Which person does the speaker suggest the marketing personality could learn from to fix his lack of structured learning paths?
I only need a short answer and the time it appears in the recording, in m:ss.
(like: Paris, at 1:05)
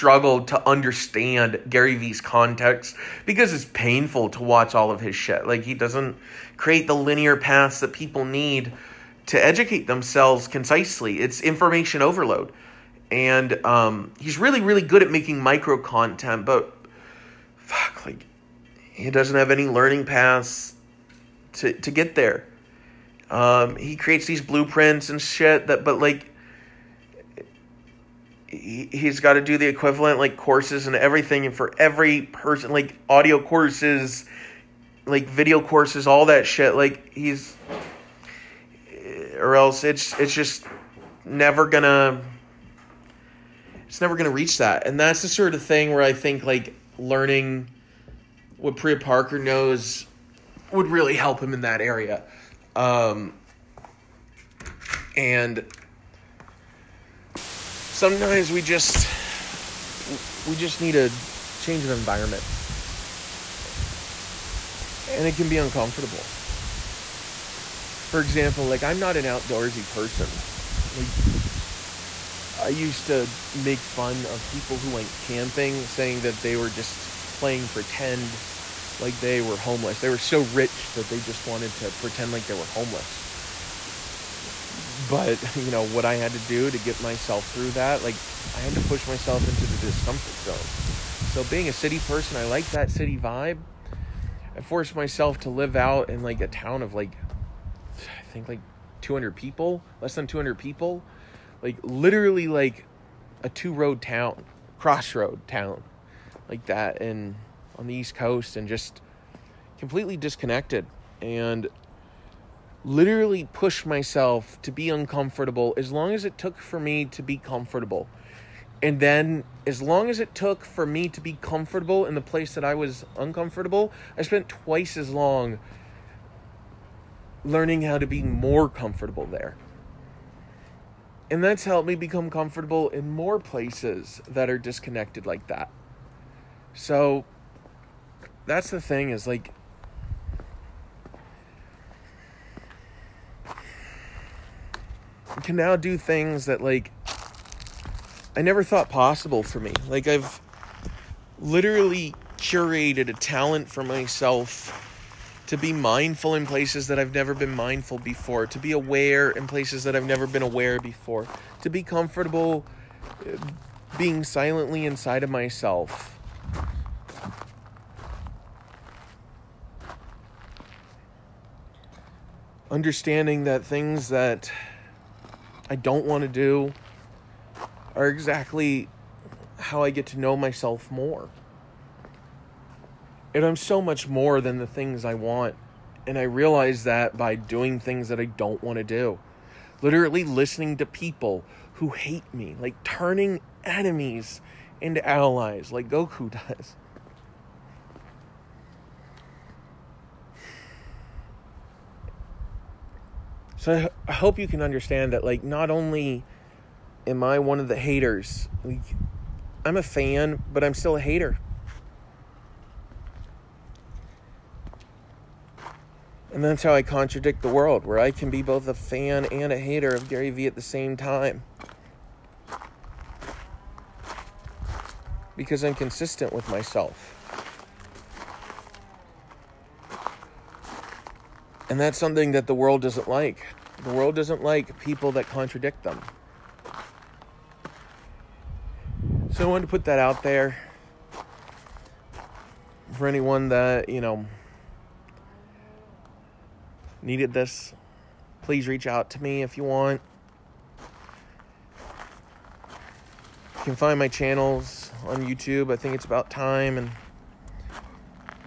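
Priya Parker, at 0:48.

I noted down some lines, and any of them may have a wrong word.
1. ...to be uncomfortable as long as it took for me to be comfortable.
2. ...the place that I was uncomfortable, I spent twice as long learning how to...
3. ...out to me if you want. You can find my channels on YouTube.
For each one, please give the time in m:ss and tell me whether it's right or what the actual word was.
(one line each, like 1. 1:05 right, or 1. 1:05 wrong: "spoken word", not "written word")
1. 1:54 right
2. 2:02 right
3. 4:08 right.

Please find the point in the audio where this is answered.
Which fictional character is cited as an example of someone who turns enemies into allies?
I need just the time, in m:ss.
3:15.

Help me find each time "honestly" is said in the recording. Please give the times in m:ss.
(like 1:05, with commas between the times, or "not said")
not said.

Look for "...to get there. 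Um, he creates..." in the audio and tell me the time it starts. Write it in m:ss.
0:21.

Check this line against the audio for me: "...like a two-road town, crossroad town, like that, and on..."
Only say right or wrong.
right.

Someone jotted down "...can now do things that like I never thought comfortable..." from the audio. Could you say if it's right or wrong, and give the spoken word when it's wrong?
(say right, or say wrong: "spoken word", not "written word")
wrong: "possible", not "comfortable".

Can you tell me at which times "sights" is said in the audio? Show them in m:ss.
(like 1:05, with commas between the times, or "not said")
not said.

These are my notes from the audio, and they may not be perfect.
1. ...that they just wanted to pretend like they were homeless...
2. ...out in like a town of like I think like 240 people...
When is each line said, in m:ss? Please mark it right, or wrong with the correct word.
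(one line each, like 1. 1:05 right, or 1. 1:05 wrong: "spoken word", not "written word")
1. 1:20 right
2. 1:35 wrong: "200", not "240".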